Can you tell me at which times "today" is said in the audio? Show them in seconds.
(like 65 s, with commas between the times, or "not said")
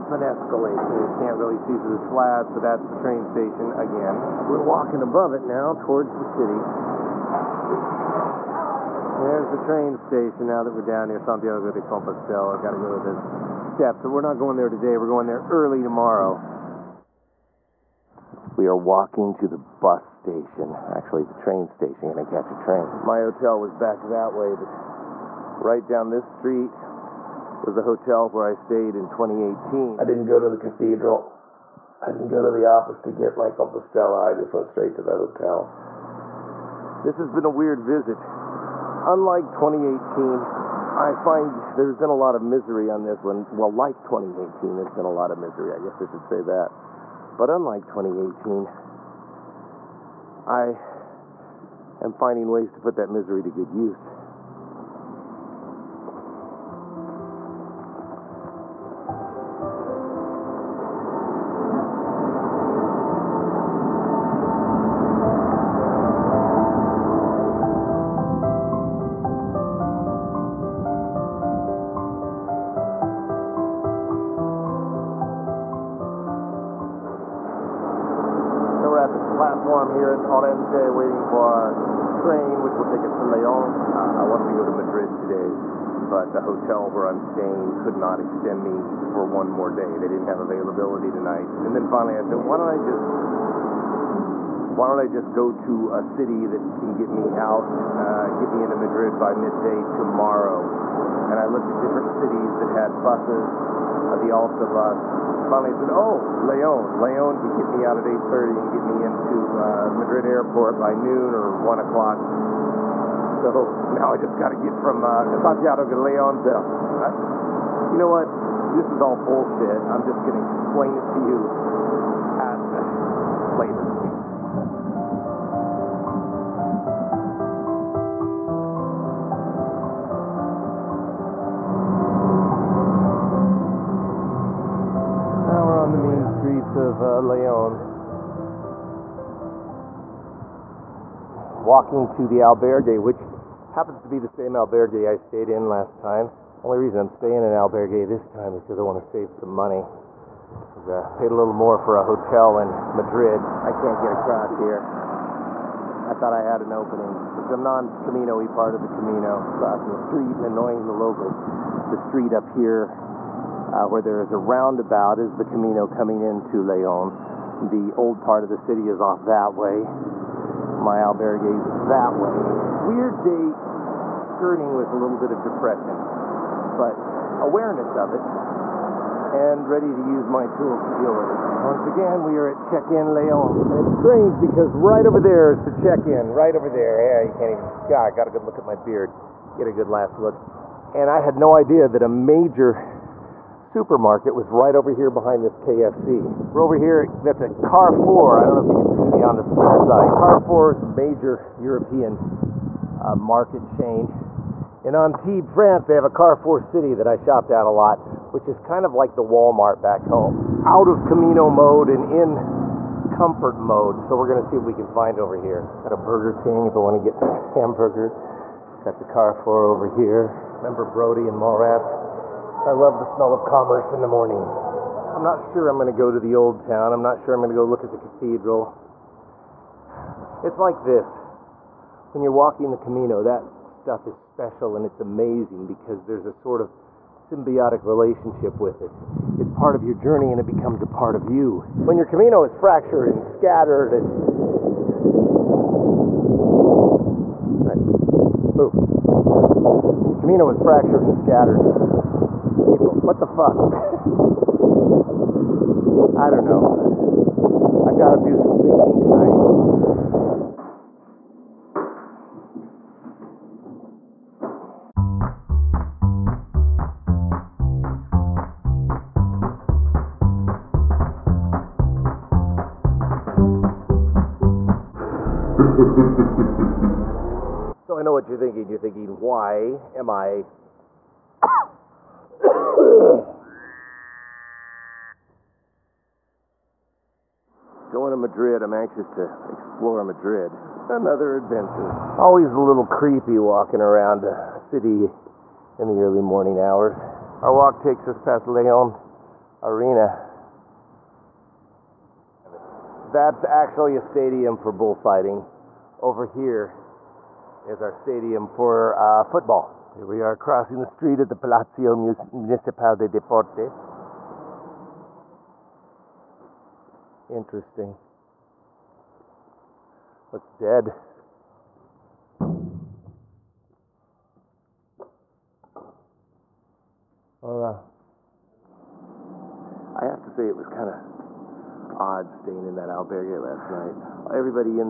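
14 s, 85 s.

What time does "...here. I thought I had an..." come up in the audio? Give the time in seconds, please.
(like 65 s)
154 s.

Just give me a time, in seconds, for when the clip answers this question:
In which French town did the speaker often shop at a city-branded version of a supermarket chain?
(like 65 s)
204 s.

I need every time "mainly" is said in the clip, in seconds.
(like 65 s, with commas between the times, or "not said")
not said.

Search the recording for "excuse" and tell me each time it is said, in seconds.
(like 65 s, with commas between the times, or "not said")
not said.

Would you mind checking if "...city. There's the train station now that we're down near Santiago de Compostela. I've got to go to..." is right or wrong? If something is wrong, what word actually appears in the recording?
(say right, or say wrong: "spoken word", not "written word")
right.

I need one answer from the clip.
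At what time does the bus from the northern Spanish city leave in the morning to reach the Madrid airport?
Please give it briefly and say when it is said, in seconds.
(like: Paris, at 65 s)
8:30, at 108 s.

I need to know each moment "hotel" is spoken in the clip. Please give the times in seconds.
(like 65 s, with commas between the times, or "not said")
23 s, 27 s, 35 s, 86 s, 152 s.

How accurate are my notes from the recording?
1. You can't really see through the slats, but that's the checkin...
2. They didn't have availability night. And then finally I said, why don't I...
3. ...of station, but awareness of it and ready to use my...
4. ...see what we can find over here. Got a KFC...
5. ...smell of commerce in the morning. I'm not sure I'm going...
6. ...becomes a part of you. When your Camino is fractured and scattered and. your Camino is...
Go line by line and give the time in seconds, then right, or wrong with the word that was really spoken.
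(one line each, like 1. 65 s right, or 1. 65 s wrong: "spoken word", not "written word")
1. 0 s wrong: "train", not "checkin"
2. 89 s wrong: "tonight", not "night"
3. 175 s wrong: "depression", not "station"
4. 214 s wrong: "Burger", not "KFC"
5. 223 s right
6. 240 s right.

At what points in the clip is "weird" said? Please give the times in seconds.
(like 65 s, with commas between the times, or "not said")
37 s, 172 s.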